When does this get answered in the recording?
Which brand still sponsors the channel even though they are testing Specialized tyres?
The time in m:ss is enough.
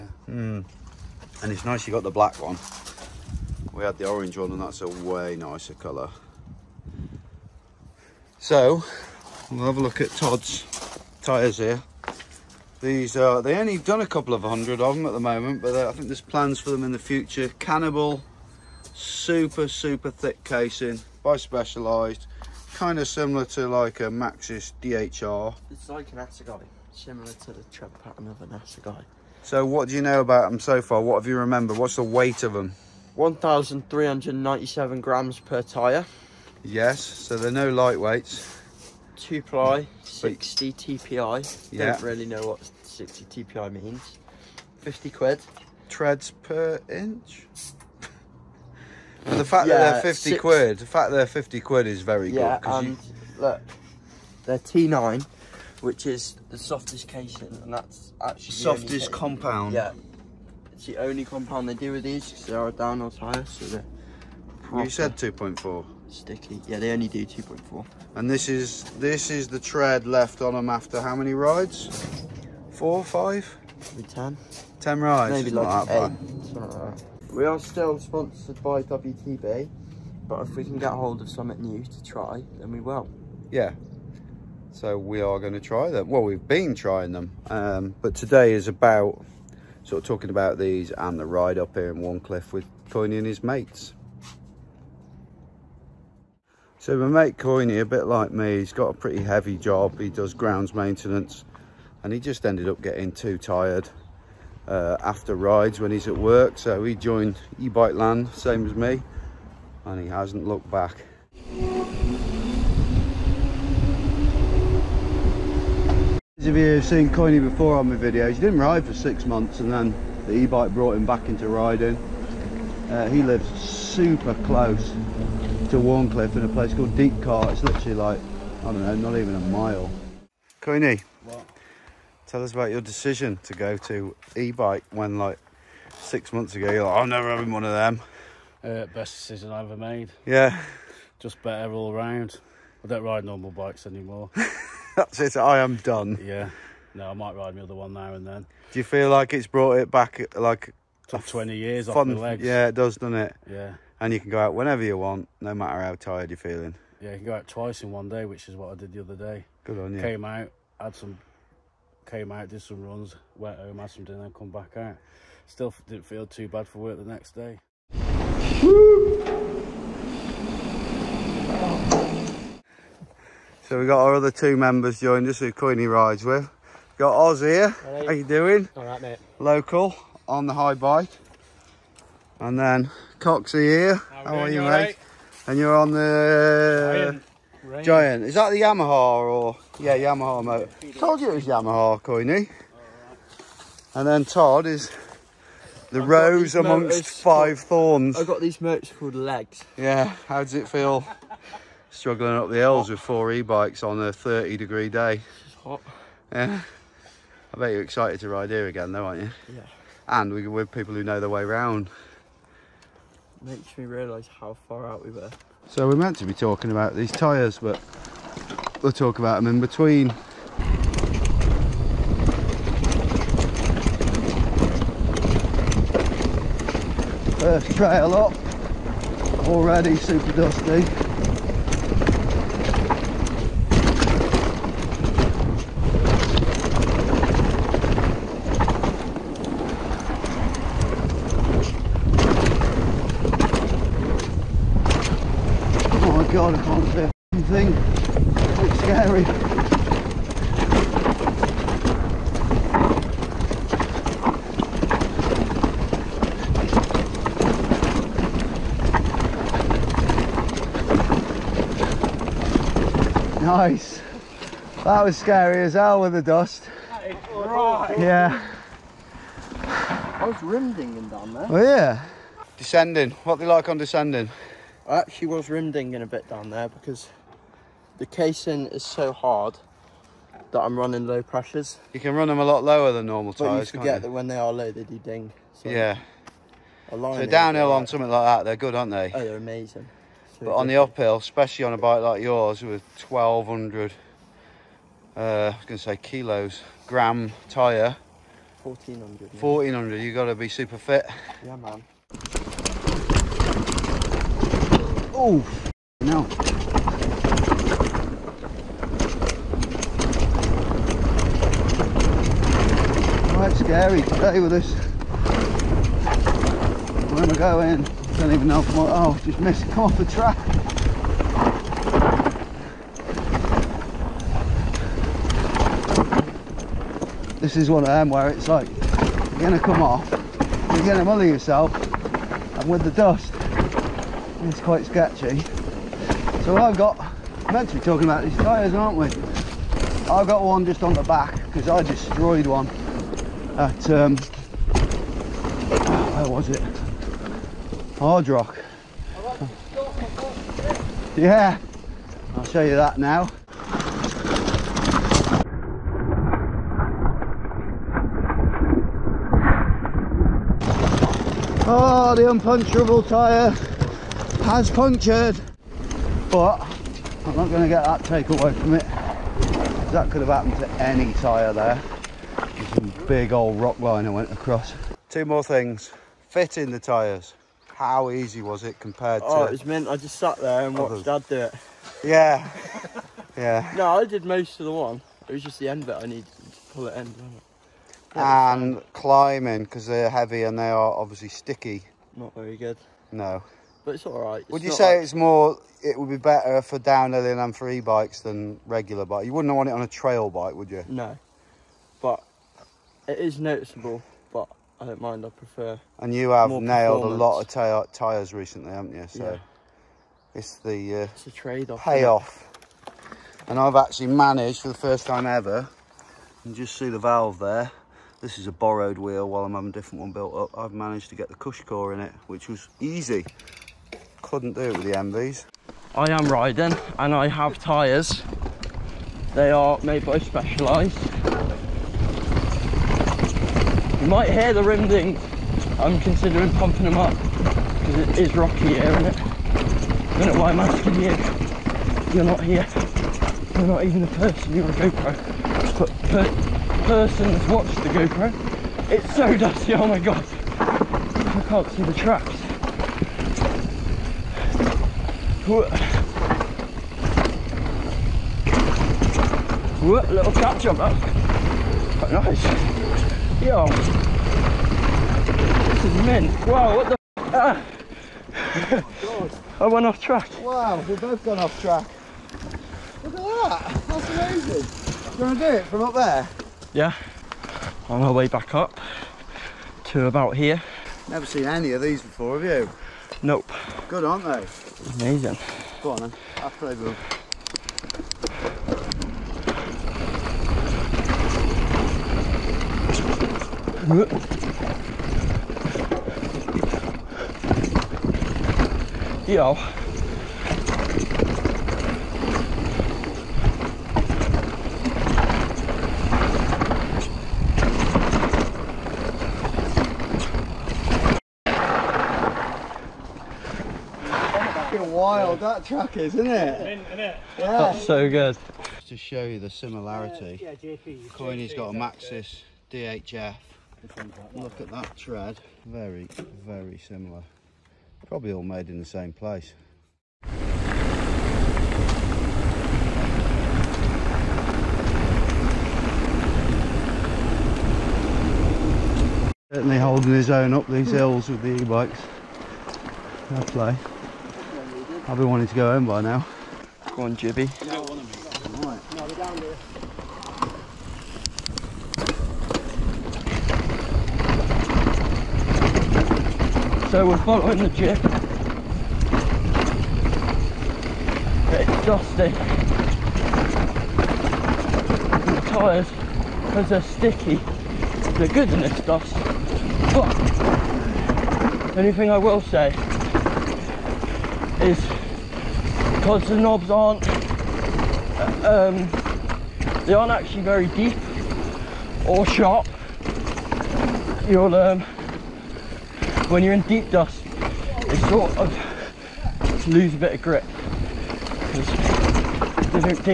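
1:18.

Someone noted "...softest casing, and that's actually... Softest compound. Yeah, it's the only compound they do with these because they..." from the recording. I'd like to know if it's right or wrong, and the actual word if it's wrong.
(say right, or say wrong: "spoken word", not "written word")
right.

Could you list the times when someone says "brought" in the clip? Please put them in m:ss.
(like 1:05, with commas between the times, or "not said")
2:00, 2:29.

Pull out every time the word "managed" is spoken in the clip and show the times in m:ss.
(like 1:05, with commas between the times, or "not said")
6:54, 7:00.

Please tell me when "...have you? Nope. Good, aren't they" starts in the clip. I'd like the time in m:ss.
8:02.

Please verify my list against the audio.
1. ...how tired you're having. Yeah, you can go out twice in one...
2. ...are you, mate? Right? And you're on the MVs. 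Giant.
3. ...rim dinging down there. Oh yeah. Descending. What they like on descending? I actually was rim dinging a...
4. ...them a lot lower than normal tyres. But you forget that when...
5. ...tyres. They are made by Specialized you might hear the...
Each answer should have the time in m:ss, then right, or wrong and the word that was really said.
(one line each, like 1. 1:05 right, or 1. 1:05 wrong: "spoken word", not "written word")
1. 2:35 wrong: "feeling", not "having"
2. 3:04 wrong: "Giant", not "MVs"
3. 4:30 right
4. 4:42 right
5. 7:07 right.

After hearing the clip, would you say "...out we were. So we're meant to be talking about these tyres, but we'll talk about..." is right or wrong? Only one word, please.
right.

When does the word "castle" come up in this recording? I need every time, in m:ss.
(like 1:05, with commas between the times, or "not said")
not said.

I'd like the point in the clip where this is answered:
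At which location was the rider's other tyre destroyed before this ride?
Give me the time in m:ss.
5:48.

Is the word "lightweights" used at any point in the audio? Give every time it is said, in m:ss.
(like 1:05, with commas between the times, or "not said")
0:37.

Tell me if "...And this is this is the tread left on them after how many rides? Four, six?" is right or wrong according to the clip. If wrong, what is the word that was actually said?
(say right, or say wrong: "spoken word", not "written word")
wrong: "five", not "six".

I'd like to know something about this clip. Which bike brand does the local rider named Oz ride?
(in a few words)
Haibike.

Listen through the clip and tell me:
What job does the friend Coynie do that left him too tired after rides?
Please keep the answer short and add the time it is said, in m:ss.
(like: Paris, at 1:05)
Grounds maintenance, at 1:40.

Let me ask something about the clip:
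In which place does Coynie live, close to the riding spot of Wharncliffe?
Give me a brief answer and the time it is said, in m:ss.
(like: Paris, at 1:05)
Deepcar, at 2:06.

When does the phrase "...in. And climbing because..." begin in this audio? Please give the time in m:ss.
6:26.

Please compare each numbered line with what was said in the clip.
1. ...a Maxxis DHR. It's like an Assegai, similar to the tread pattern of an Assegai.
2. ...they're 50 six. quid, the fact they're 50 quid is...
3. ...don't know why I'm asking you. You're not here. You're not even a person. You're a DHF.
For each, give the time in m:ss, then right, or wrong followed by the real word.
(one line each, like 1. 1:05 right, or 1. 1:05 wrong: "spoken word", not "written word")
1. 0:23 right
2. 0:50 right
3. 7:20 wrong: "GoPro", not "DHF".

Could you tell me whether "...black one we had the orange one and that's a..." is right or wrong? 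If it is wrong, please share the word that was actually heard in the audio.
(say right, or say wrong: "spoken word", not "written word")
right.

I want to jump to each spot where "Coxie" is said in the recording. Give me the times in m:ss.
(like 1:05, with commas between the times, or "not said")
3:03.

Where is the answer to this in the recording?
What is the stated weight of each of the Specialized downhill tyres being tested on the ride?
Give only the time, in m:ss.
0:33.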